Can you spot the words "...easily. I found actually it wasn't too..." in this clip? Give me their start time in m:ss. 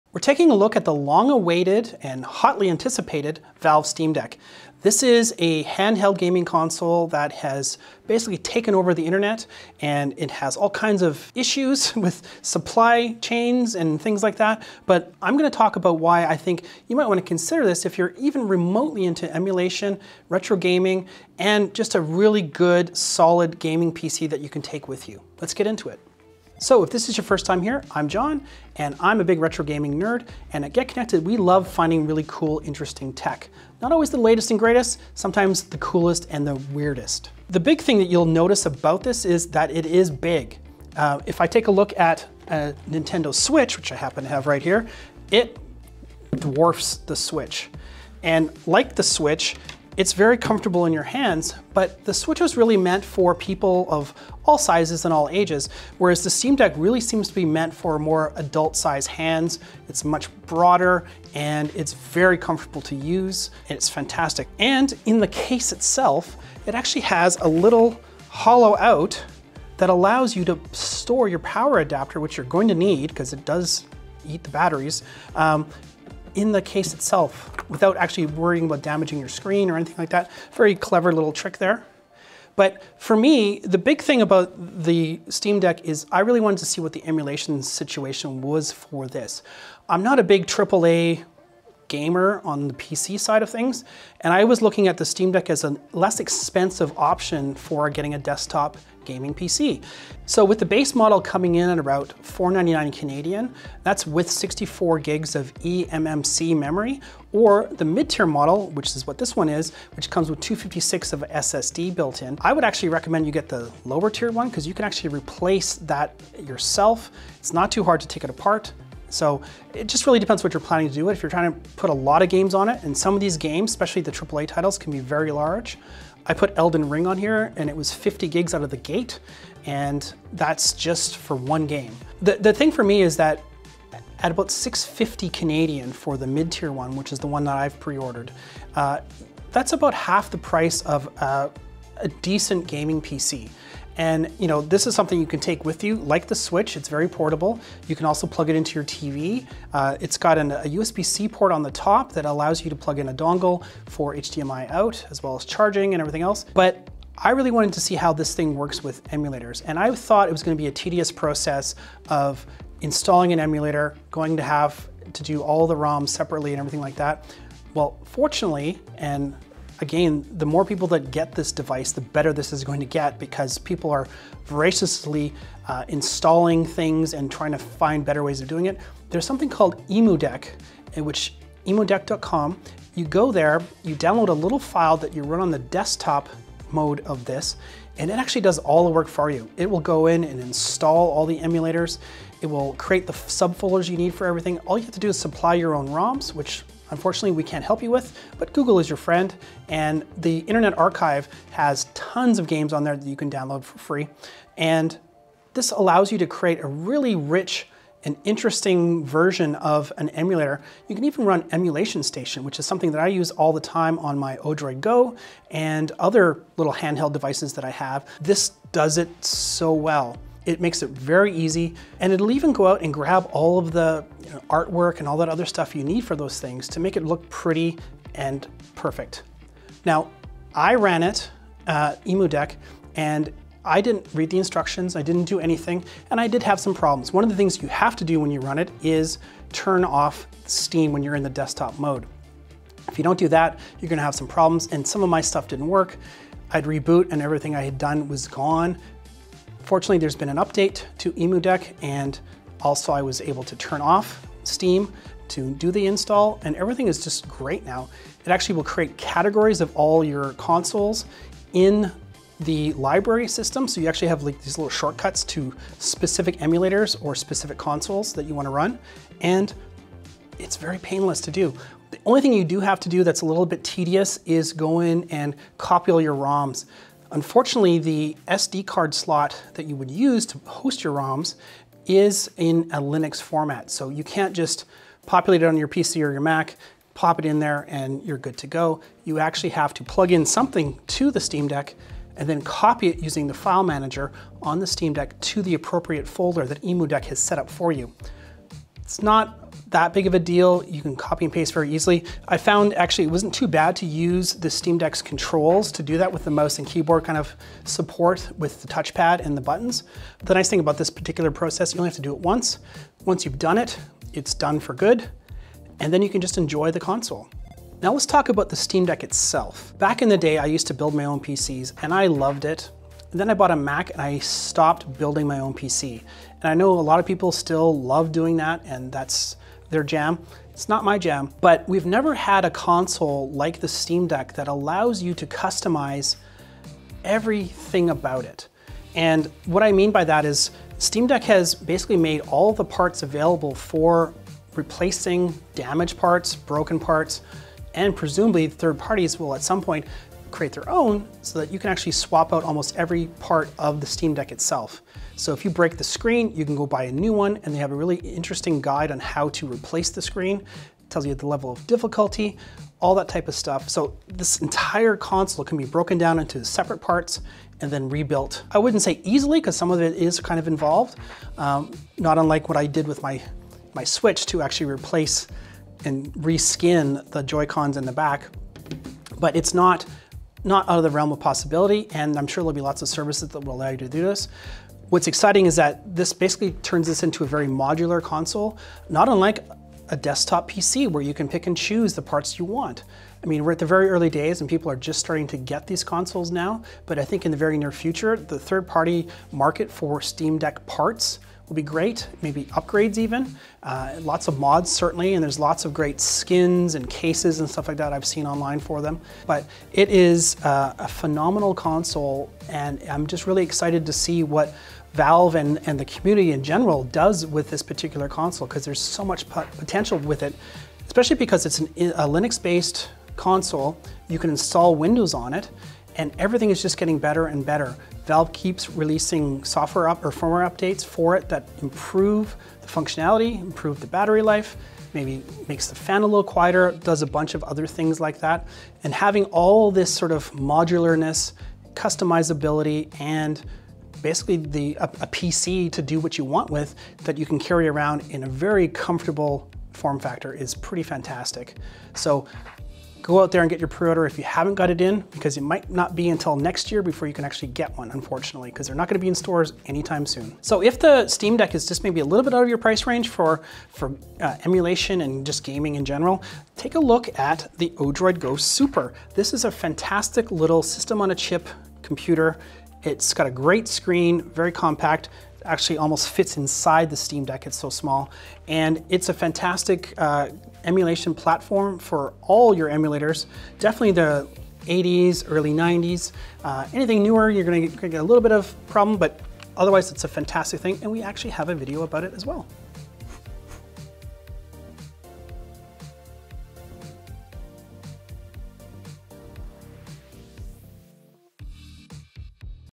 5:01.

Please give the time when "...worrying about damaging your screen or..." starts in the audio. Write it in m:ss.
1:18.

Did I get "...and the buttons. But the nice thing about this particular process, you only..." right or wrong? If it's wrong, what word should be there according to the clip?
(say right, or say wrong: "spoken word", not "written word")
right.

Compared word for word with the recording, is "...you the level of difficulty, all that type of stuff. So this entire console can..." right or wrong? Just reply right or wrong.
right.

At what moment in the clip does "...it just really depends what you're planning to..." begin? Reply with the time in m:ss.
1:59.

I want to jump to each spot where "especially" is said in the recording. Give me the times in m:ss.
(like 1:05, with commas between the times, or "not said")
2:03, 7:00.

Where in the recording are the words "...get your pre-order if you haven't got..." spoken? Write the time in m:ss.
7:33.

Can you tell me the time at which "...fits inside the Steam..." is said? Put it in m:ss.
7:56.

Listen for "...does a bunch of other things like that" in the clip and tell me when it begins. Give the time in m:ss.
7:16.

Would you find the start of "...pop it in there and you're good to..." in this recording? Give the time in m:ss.
4:46.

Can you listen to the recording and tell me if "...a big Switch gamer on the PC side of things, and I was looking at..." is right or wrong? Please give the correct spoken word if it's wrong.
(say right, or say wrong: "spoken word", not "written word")
wrong: "AAA", not "Switch".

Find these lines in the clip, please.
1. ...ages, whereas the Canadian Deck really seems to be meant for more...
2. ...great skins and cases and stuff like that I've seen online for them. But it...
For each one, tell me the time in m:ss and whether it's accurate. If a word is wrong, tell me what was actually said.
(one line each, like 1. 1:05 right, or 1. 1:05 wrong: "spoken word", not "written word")
1. 0:55 wrong: "Steam", not "Canadian"
2. 6:45 right.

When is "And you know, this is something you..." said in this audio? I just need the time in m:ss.
2:23.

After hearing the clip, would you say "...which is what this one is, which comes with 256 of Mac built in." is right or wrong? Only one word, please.
wrong.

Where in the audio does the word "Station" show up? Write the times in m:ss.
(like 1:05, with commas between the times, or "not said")
3:32.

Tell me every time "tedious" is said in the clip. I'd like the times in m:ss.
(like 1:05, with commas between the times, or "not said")
2:40, 4:33.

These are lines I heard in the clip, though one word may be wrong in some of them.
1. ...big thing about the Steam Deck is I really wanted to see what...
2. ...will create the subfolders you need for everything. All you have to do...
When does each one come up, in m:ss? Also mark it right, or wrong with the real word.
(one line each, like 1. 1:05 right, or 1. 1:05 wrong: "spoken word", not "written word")
1. 1:23 right
2. 3:12 right.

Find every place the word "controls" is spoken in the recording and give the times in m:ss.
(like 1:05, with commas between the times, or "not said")
5:05.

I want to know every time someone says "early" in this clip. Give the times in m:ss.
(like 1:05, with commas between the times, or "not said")
6:33, 8:05.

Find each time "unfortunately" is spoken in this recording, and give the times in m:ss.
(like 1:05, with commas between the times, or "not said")
3:16, 4:37, 7:37.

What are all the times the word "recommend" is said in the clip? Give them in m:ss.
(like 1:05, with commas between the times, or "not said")
1:52.